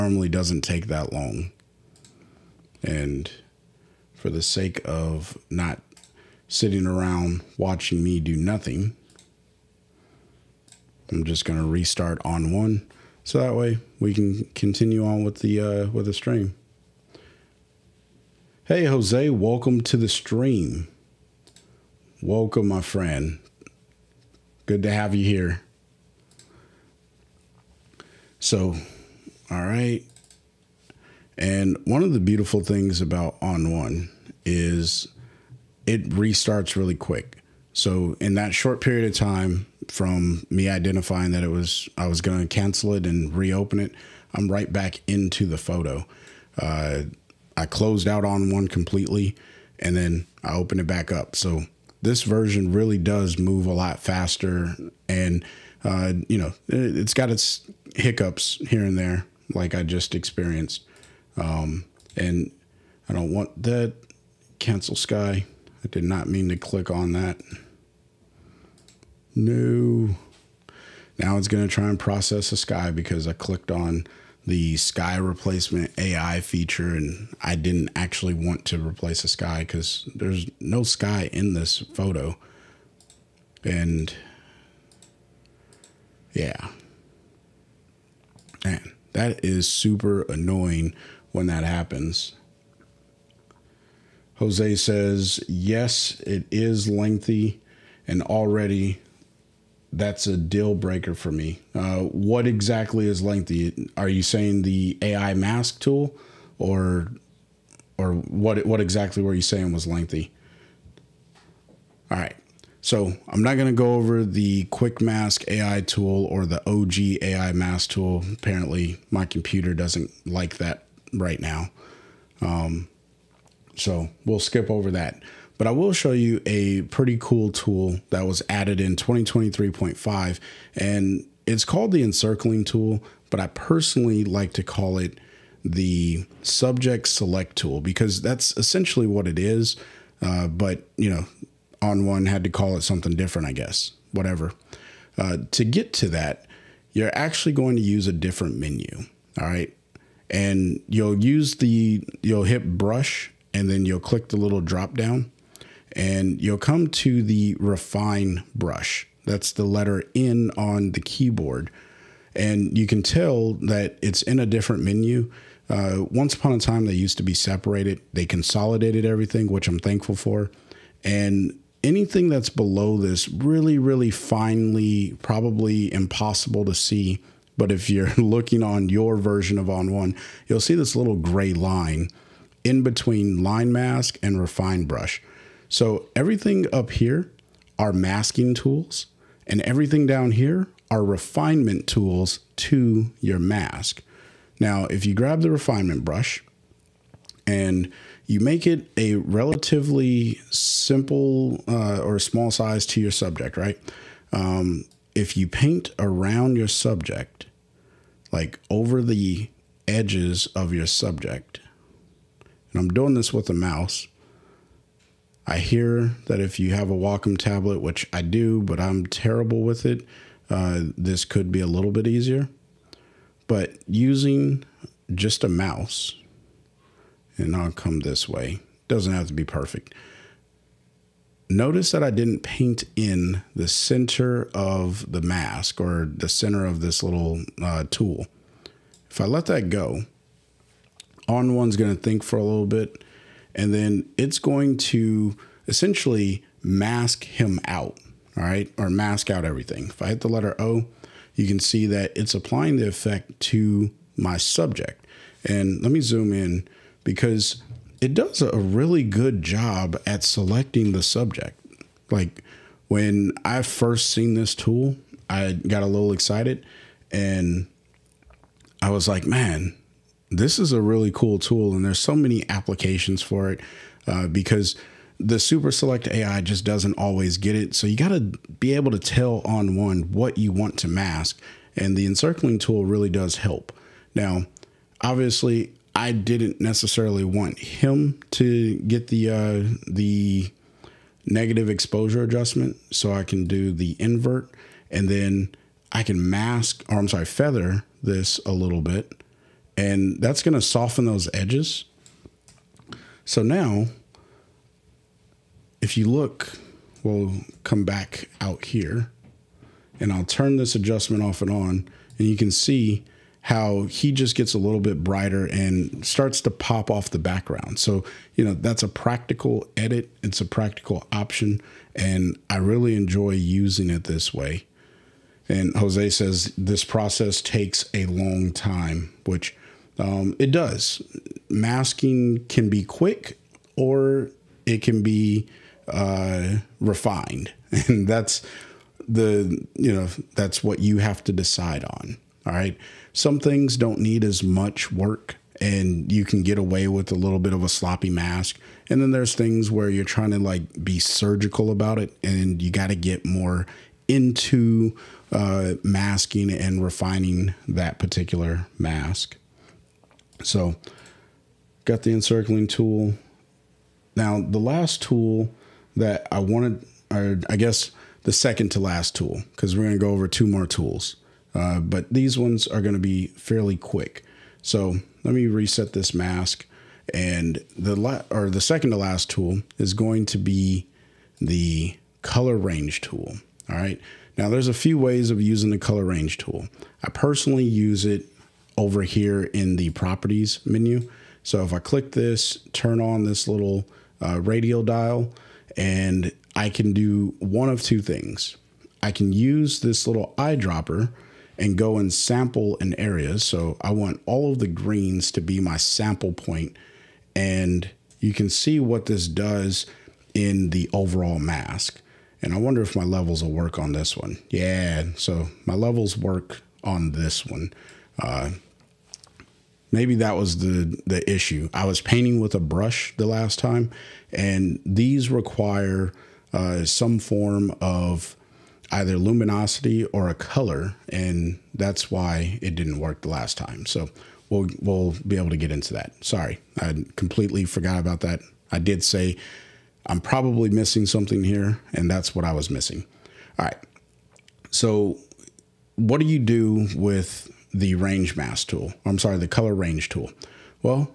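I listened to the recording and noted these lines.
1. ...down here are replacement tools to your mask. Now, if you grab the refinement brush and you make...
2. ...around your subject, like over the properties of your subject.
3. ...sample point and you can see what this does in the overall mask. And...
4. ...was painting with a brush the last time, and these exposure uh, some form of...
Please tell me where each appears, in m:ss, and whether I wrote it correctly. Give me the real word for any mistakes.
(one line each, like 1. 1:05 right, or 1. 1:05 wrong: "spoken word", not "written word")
1. 3:10 wrong: "refinement", not "replacement"
2. 3:25 wrong: "edges", not "properties"
3. 6:45 right
4. 7:01 wrong: "require", not "exposure".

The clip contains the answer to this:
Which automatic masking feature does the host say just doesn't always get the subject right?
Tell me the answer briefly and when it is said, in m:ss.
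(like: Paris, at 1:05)
super select AI, at 4:35.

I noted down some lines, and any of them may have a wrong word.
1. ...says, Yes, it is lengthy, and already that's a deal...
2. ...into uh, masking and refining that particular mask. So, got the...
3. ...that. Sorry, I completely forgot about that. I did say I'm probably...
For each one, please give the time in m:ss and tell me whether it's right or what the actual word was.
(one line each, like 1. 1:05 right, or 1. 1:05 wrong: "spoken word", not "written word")
1. 1:34 right
2. 5:54 right
3. 7:15 right.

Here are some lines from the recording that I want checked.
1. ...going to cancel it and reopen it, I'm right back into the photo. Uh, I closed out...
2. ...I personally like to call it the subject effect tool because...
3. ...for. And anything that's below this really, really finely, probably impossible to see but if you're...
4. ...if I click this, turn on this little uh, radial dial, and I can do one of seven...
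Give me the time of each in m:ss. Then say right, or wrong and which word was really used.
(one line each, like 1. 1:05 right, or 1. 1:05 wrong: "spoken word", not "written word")
1. 0:42 right
2. 2:13 wrong: "select", not "effect"
3. 2:50 right
4. 6:31 wrong: "two", not "seven".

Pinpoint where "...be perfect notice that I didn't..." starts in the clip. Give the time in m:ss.
3:49.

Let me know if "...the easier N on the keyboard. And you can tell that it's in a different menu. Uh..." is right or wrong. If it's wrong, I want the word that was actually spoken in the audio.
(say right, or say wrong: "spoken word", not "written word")
wrong: "letter", not "easier".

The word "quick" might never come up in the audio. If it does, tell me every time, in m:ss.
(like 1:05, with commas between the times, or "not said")
0:36, 1:54, 5:32, 6:13.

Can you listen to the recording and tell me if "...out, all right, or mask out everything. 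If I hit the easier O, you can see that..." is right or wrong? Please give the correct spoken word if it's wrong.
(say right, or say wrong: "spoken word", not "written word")
wrong: "letter", not "easier".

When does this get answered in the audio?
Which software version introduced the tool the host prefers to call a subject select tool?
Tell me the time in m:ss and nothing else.
2:08.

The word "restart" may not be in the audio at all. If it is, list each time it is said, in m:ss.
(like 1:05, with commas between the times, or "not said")
0:11, 0:36.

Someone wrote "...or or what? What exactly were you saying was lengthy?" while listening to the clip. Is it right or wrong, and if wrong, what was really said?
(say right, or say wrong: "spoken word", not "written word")
right.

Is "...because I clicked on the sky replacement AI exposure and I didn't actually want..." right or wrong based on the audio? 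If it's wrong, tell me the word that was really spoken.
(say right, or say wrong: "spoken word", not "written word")
wrong: "feature", not "exposure".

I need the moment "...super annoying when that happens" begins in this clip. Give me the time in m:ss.
1:29.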